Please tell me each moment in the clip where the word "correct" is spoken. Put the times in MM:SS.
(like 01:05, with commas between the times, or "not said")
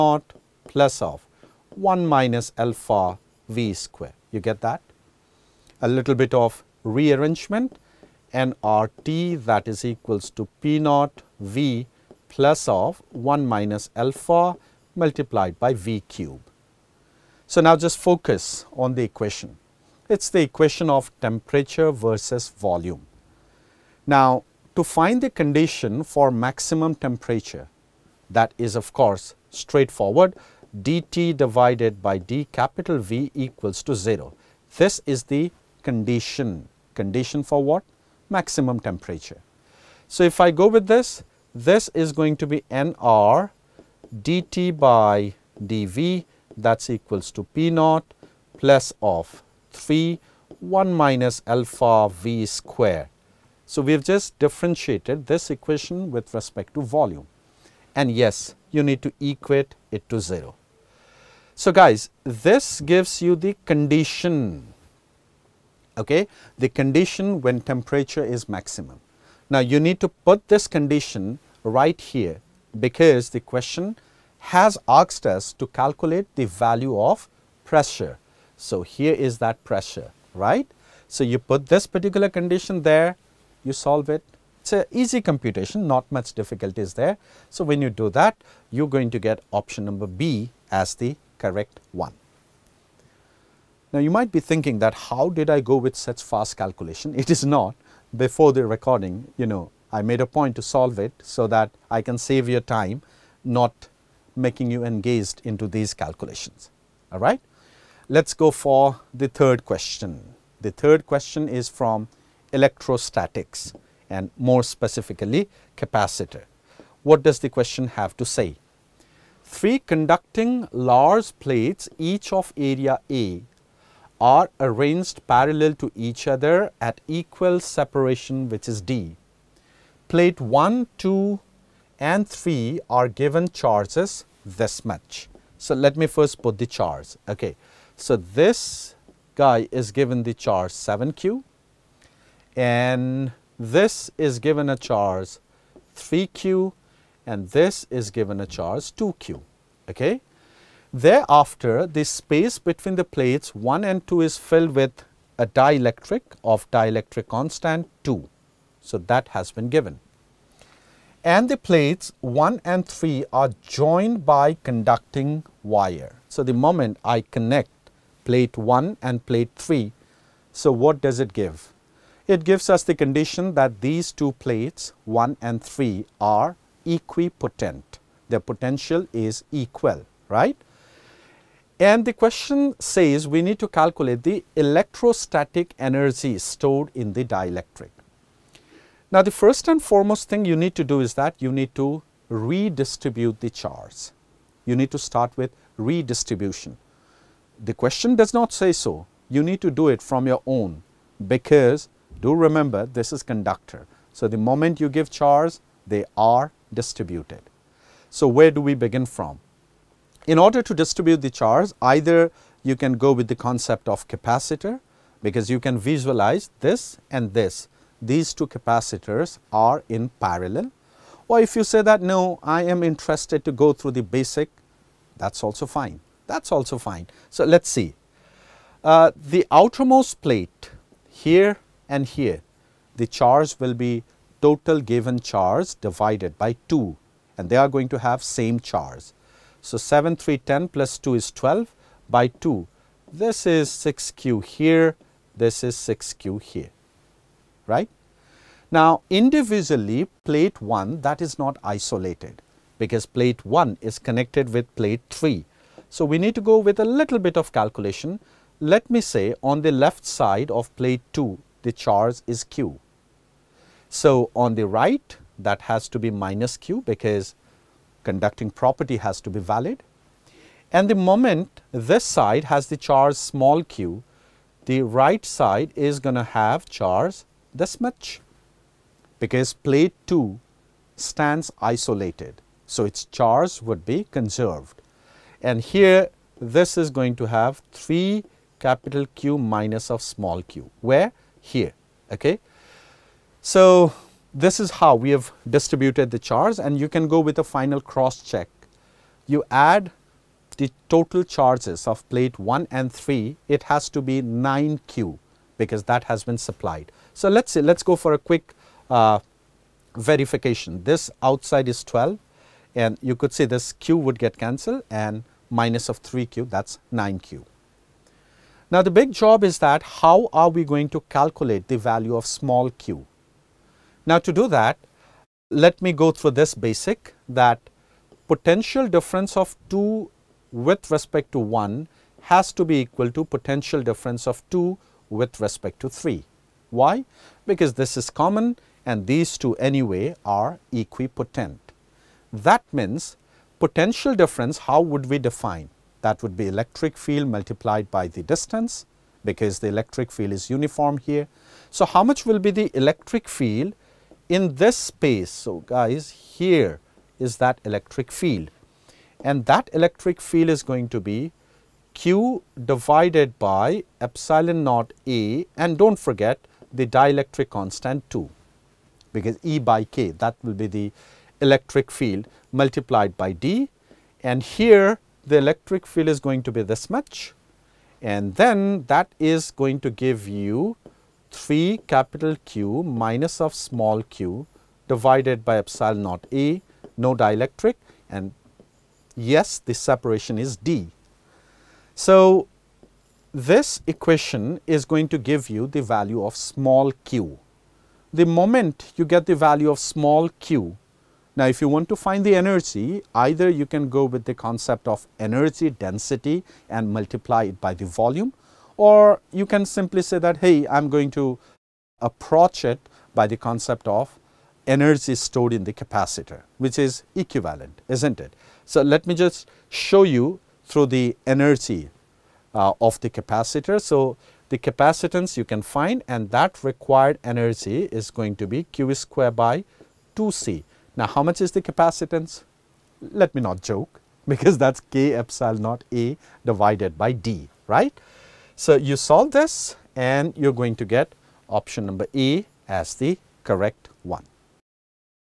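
01:31, 07:23.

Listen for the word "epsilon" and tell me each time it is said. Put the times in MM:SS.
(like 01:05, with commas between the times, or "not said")
06:03, 06:25, 07:15.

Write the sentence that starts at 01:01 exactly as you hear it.
So, guys, this gives you the condition, okay, the condition when temperature is maximum.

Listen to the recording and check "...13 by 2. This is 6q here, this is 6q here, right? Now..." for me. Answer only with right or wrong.
wrong.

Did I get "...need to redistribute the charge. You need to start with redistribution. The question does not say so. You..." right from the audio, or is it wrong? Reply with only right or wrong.
right.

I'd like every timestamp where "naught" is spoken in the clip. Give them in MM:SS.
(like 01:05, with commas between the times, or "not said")
00:10, 00:47, 06:04, 06:26, 07:15.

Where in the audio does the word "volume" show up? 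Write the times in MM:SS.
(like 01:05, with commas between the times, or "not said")
00:22, 00:56, 06:47.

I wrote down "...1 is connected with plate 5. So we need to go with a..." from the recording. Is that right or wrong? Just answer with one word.
wrong.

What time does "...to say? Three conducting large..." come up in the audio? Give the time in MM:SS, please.
01:58.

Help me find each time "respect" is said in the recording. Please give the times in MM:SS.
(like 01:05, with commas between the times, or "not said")
00:56, 05:30, 05:35.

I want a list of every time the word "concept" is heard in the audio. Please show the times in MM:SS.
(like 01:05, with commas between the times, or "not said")
03:33, 06:44, 06:53.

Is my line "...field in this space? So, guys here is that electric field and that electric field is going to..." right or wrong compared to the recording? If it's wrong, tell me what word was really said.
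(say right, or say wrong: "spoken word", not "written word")
right.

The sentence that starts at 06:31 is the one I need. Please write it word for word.
So, this equation is going to give you the value of small q.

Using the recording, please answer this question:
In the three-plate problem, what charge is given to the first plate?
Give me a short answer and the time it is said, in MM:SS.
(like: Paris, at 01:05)
7q, at 02:20.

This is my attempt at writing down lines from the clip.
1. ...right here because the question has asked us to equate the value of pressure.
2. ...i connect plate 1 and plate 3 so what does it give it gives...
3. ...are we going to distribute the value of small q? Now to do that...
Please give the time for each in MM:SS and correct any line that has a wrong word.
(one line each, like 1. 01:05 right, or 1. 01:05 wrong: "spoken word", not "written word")
1. 01:11 wrong: "calculate", not "equate"
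2. 02:47 right
3. 05:20 wrong: "calculate", not "distribute".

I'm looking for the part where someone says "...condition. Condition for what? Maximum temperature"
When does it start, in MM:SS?
00:35.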